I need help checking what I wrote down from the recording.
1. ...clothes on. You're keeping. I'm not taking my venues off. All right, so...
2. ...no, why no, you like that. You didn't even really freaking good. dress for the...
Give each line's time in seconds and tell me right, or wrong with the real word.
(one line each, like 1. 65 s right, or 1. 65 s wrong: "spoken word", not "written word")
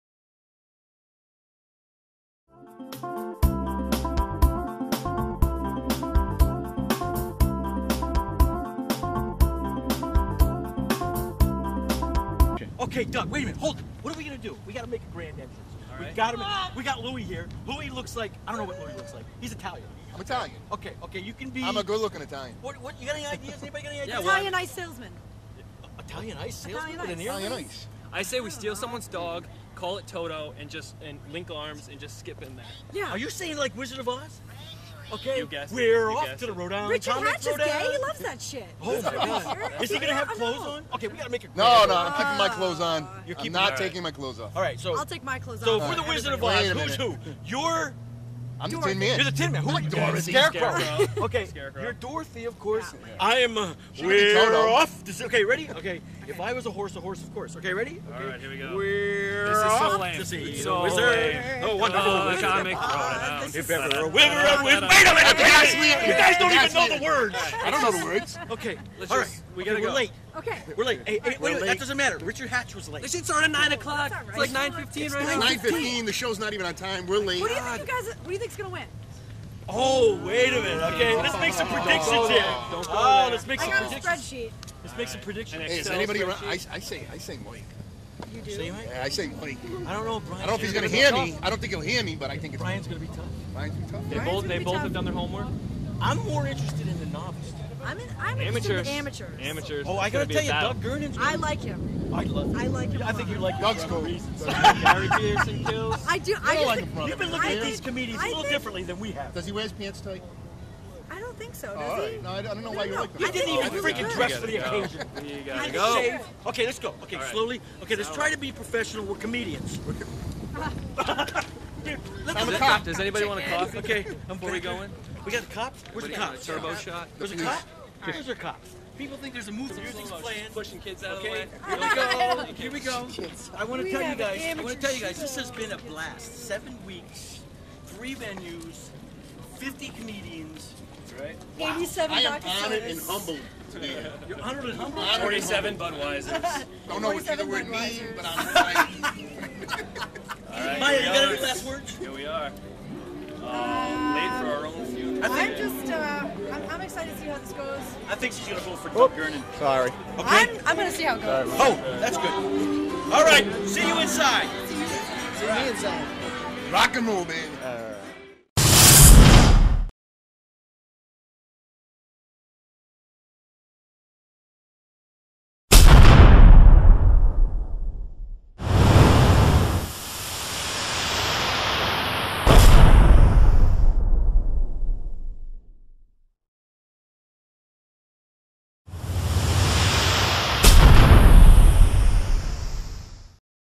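1. 42 s wrong: "clothes", not "venues"
2. 112 s right.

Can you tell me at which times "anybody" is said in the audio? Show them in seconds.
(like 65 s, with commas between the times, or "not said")
23 s, 85 s, 123 s.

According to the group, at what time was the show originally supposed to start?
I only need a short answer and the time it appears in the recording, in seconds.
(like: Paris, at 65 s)
9 o'clock, at 73 s.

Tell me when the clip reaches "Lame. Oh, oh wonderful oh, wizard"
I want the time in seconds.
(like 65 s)
61 s.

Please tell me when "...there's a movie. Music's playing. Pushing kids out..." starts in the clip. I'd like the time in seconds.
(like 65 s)
129 s.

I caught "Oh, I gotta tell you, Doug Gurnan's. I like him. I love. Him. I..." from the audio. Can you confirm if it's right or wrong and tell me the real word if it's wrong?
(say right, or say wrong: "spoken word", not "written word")
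right.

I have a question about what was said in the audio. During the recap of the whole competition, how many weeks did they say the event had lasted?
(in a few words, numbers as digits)
7.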